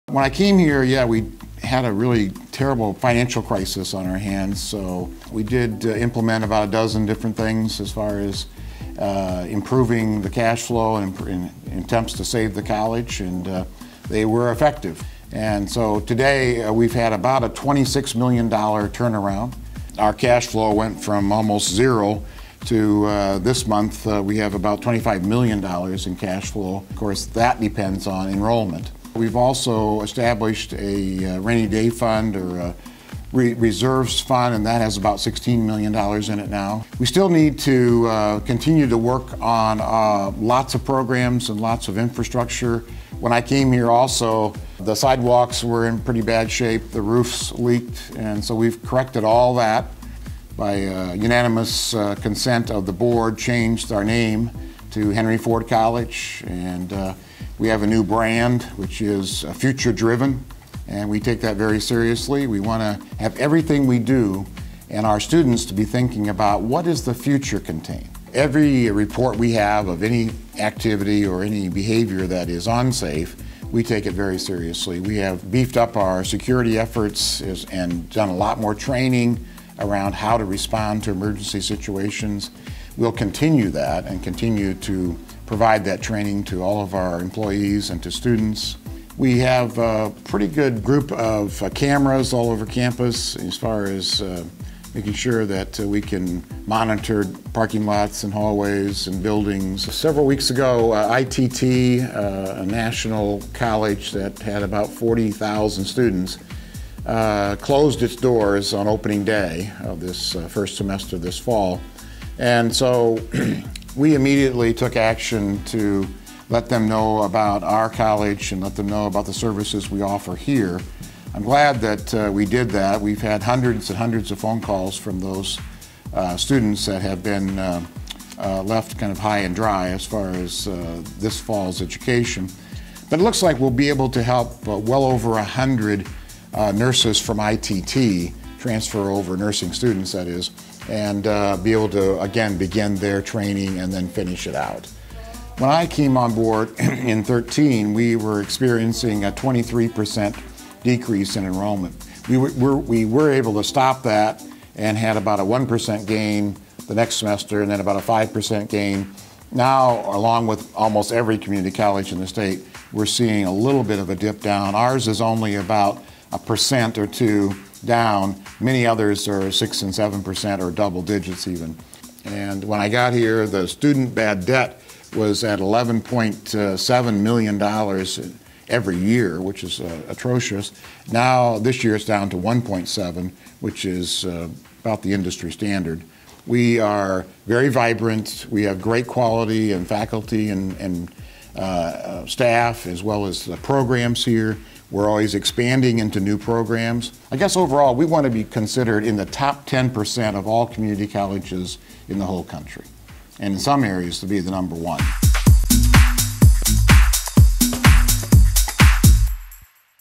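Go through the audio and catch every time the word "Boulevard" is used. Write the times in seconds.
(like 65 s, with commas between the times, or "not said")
not said.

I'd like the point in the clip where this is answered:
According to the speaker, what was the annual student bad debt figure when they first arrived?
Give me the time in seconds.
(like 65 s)
175 s.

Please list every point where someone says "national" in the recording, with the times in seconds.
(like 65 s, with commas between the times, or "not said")
102 s.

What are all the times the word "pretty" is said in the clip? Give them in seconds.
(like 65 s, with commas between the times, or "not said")
45 s, 90 s.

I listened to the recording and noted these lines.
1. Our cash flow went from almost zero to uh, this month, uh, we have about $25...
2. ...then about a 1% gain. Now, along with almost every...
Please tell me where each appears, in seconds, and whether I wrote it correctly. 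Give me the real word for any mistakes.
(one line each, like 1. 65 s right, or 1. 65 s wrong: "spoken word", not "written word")
1. 19 s right
2. 157 s wrong: "5", not "1".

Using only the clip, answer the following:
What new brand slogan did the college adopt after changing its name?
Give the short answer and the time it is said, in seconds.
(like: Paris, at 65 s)
future driven, at 59 s.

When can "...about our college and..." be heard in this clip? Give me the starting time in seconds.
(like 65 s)
117 s.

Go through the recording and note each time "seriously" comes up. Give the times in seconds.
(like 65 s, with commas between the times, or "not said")
61 s, 74 s.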